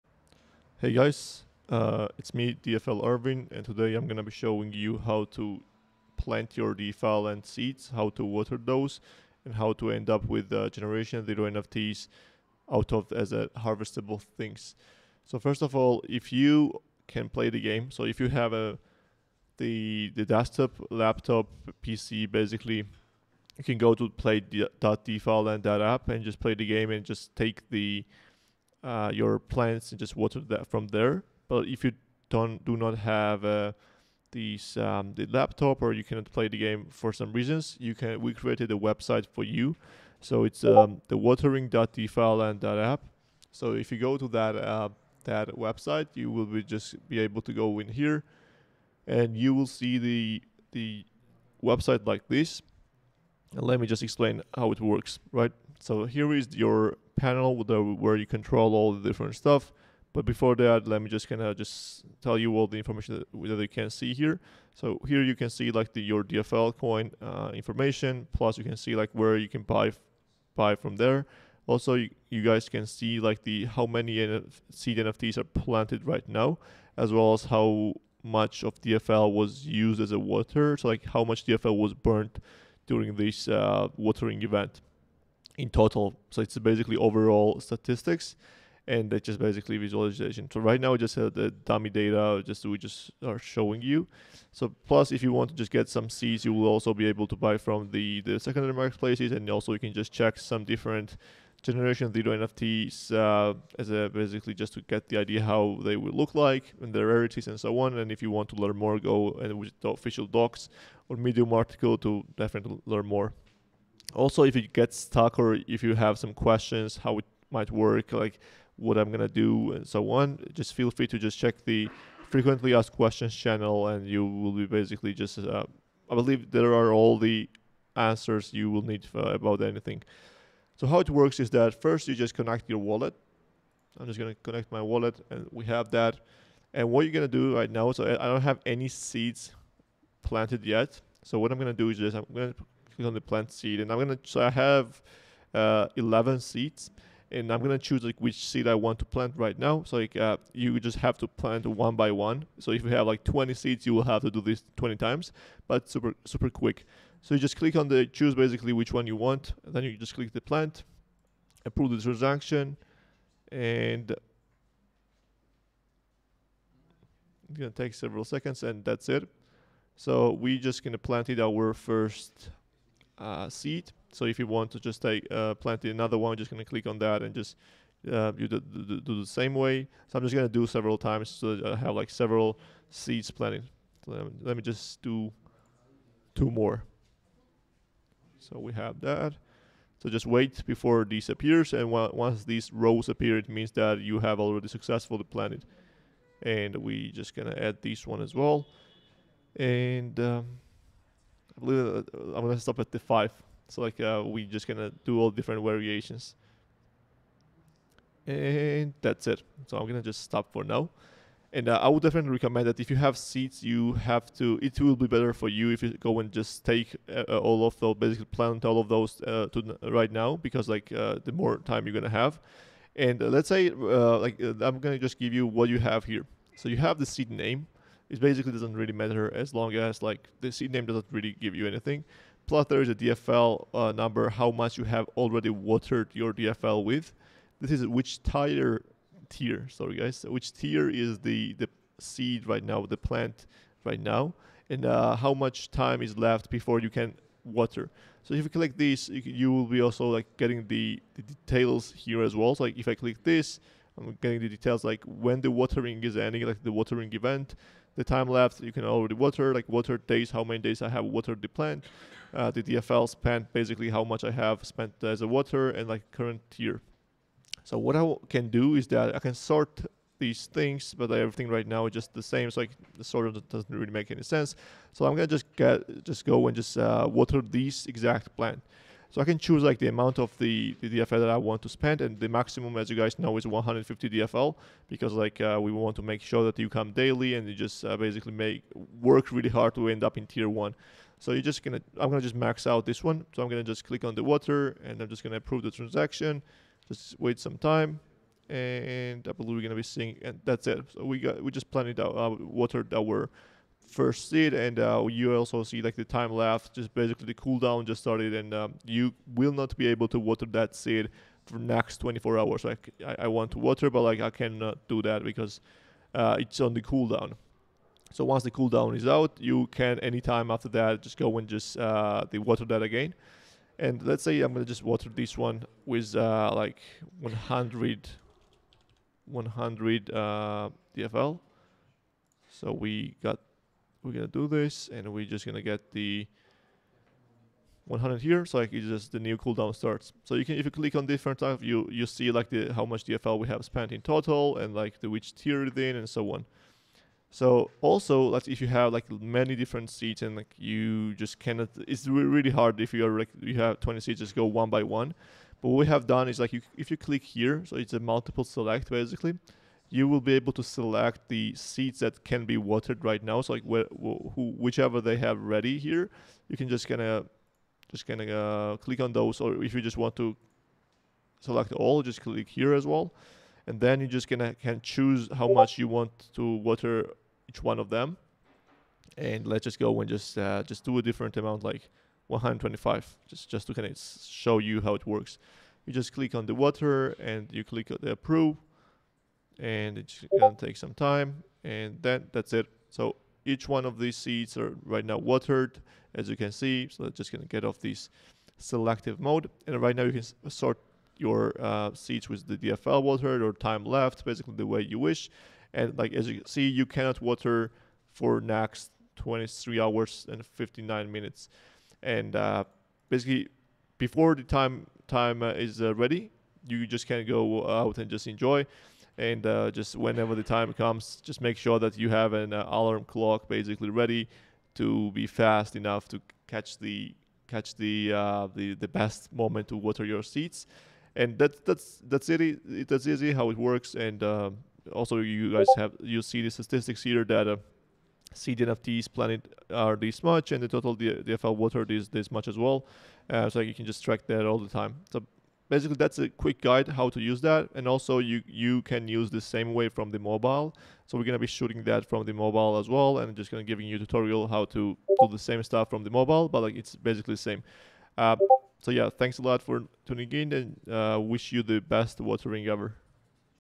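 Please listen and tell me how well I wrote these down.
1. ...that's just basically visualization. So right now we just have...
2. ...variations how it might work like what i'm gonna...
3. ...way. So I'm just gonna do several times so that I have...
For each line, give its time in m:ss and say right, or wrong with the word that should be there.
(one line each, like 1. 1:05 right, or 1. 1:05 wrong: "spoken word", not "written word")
1. 1:29 right
2. 1:56 wrong: "questions", not "variations"
3. 2:59 right.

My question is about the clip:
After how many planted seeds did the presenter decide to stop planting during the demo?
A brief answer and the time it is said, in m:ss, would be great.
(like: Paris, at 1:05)
5, at 3:22.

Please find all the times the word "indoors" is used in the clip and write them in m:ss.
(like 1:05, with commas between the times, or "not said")
not said.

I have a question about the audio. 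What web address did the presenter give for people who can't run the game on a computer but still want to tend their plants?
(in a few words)
defiland.app.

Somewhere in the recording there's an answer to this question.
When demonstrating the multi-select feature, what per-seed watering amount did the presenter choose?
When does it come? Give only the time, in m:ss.
6:22.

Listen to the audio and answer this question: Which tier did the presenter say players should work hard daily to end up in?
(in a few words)
tier one.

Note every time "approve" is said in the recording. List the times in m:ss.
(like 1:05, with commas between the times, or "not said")
2:41, 4:55, 6:28.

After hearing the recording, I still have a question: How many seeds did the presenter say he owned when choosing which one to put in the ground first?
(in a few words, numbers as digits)
11.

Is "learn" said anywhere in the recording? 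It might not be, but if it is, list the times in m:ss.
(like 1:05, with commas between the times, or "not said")
1:48, 1:52.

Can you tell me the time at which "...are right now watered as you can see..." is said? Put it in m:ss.
6:34.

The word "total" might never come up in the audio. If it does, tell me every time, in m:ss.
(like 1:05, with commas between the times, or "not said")
1:25, 5:44, 7:20.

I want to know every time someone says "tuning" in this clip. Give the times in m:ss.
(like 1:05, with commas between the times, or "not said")
7:40.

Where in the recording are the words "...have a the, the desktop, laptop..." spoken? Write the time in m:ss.
0:18.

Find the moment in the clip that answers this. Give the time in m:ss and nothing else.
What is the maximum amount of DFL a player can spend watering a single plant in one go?
4:43.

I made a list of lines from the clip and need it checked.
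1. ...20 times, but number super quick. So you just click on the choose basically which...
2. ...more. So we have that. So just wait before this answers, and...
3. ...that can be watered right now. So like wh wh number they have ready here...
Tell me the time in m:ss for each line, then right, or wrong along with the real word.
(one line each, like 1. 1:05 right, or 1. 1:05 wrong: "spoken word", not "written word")
1. 2:34 wrong: "super", not "number"
2. 3:06 wrong: "appears", not "answers"
3. 6:01 wrong: "whichever", not "number".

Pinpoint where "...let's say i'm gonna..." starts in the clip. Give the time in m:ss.
5:24.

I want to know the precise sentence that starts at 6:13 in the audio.
And then you just gonna can choose how much you want to water each one of them.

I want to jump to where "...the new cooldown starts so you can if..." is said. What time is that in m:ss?
5:39.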